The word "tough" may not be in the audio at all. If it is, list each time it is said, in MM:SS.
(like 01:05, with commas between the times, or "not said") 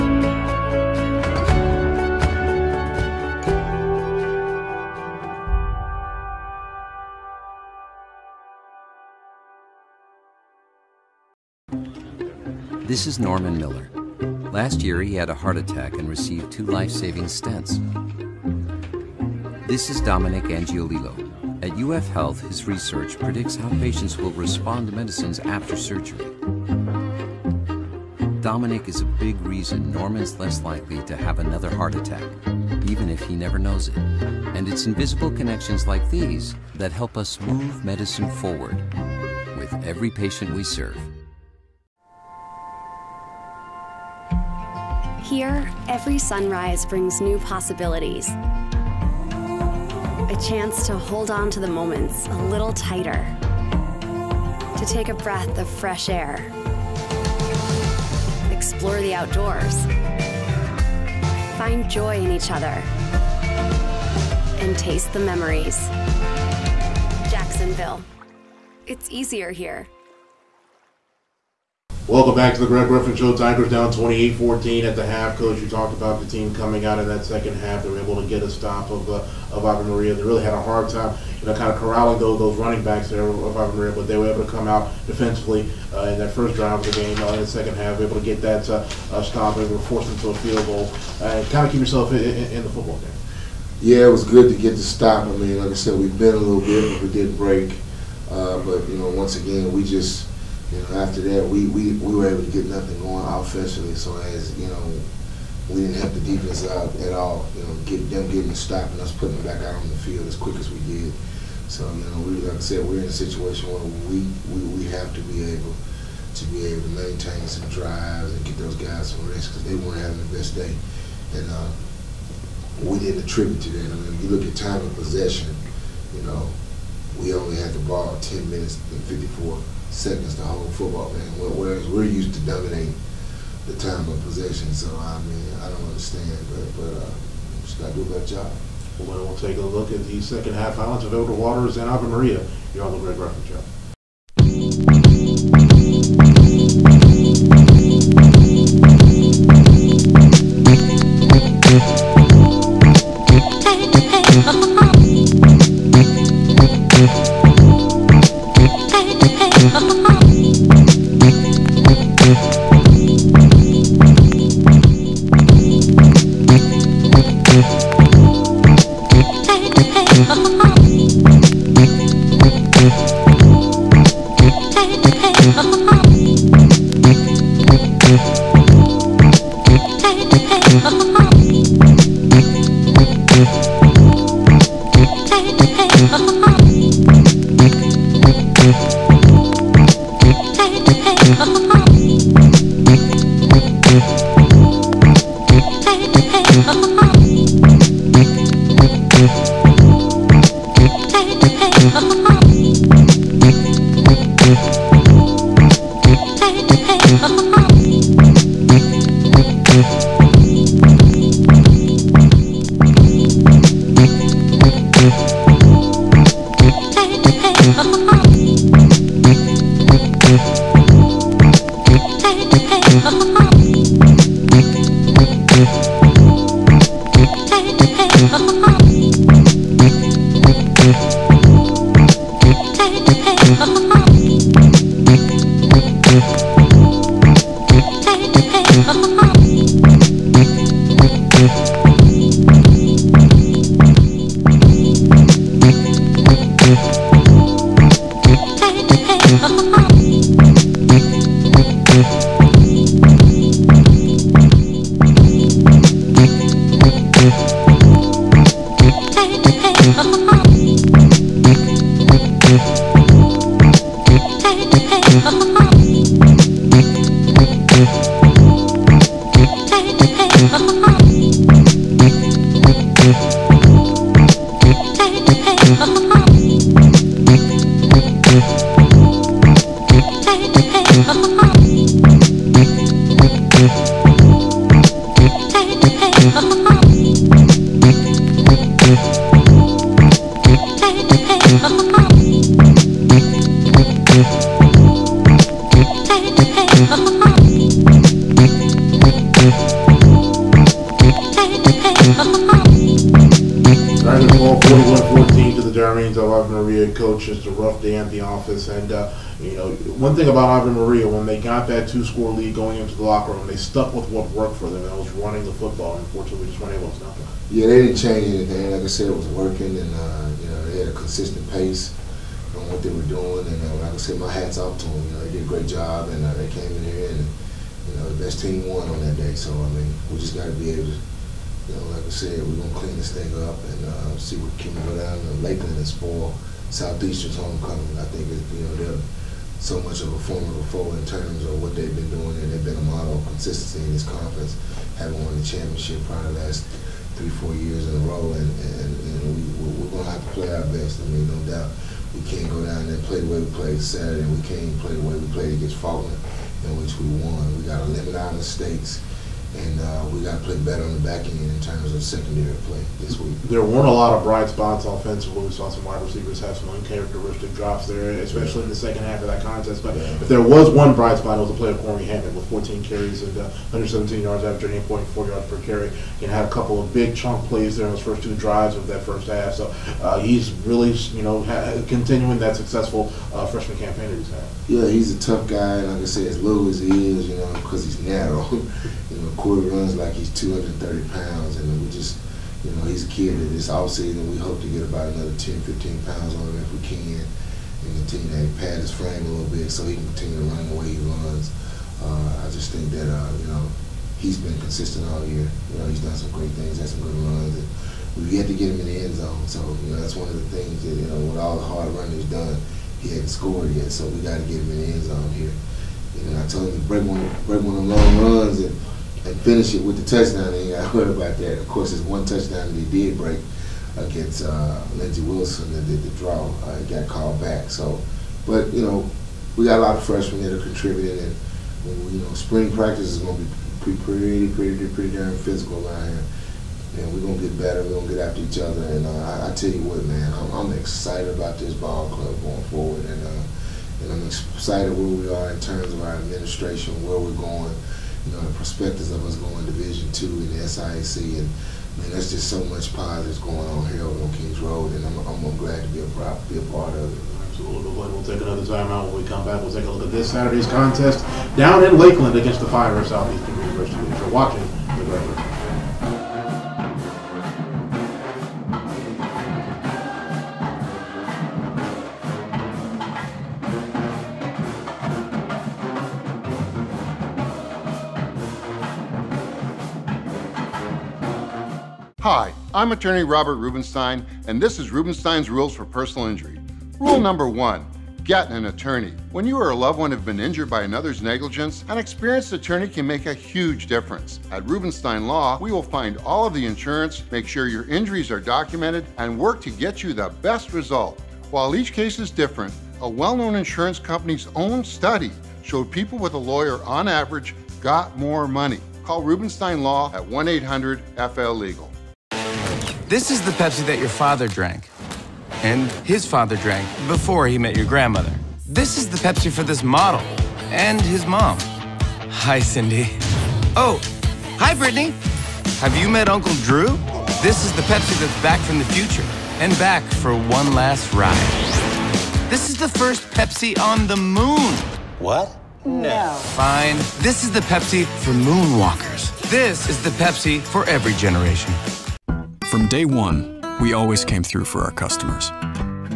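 06:25.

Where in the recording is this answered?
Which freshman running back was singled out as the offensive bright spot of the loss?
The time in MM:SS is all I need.
06:11.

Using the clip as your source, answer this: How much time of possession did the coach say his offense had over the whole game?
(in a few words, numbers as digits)
10 minutes and 54 seconds.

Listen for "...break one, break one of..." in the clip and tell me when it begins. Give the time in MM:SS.
06:56.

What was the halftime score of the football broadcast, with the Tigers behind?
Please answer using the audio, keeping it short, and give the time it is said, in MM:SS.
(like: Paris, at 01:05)
28-14, at 01:13.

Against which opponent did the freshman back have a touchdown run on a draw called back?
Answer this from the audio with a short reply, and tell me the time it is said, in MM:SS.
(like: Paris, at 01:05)
Lindsey Wilson, at 07:04.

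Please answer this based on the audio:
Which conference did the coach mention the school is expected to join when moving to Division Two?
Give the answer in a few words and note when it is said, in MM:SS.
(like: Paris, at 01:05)
SIAC, at 07:30.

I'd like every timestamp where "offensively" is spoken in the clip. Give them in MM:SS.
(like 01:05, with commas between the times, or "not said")
01:43, 06:04.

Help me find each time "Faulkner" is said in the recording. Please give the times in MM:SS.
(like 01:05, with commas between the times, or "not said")
05:55.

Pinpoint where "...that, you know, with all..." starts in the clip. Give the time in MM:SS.
06:50.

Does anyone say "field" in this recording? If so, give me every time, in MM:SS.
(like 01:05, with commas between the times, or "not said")
01:30, 01:50.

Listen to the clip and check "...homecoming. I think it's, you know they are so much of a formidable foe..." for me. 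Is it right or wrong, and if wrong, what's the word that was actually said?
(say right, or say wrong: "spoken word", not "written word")
right.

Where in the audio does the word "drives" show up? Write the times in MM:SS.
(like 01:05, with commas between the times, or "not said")
01:26, 01:57, 06:18.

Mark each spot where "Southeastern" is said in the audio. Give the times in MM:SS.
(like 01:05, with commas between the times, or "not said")
05:36, 07:43.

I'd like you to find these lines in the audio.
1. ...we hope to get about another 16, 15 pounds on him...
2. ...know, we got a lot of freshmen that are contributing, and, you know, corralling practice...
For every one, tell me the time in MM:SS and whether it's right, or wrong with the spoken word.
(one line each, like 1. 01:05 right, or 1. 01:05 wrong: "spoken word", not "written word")
1. 06:34 wrong: "10", not "16"
2. 07:08 wrong: "spring", not "corralling".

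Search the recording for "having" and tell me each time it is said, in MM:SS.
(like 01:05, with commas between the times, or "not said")
02:00, 05:44.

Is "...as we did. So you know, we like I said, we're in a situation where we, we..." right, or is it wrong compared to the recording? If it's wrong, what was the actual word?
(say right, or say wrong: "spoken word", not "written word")
right.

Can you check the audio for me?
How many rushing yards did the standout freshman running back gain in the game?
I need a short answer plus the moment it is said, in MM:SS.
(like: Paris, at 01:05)
117, at 06:13.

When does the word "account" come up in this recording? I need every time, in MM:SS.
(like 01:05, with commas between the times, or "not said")
not said.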